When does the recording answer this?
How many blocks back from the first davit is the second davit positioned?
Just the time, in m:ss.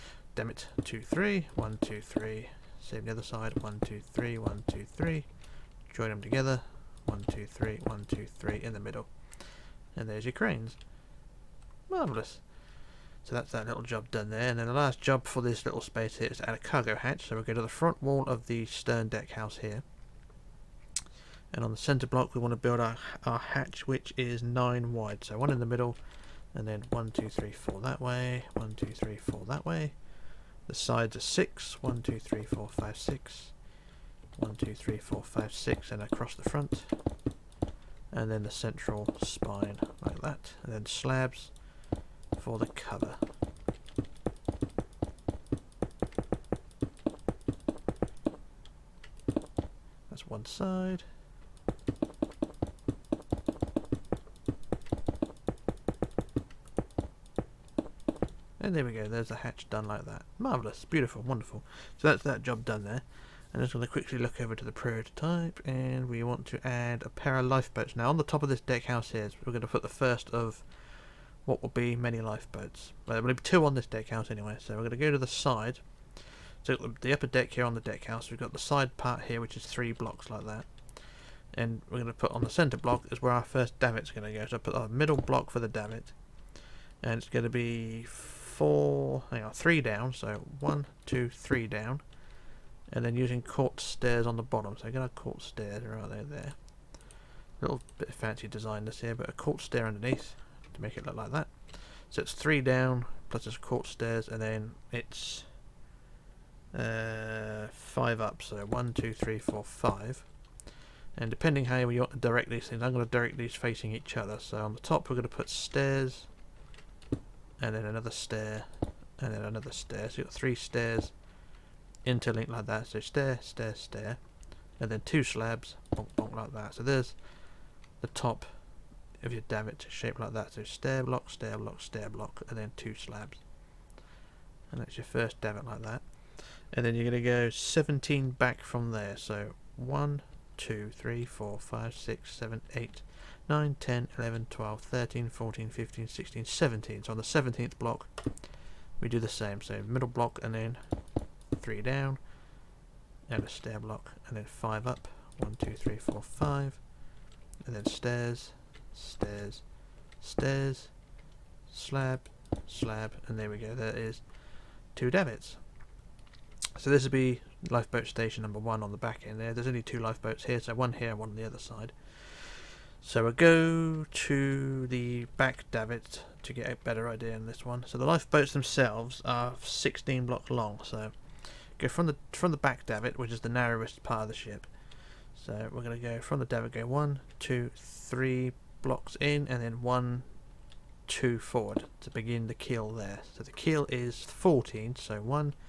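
2:17.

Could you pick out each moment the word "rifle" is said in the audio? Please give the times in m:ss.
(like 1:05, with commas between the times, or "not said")
not said.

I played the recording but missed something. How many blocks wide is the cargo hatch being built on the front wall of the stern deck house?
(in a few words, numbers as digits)
9.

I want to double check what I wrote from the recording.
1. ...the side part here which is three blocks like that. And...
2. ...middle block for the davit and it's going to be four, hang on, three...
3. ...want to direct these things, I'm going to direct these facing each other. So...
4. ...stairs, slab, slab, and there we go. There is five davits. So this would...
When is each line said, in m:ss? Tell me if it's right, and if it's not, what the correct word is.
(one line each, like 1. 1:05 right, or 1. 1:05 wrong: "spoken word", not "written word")
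1. 1:18 right
2. 1:24 right
3. 1:51 right
4. 2:40 wrong: "two", not "five".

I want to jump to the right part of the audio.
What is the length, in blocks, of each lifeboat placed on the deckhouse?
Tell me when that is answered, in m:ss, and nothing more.
2:59.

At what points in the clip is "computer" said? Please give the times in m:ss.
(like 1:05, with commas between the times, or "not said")
not said.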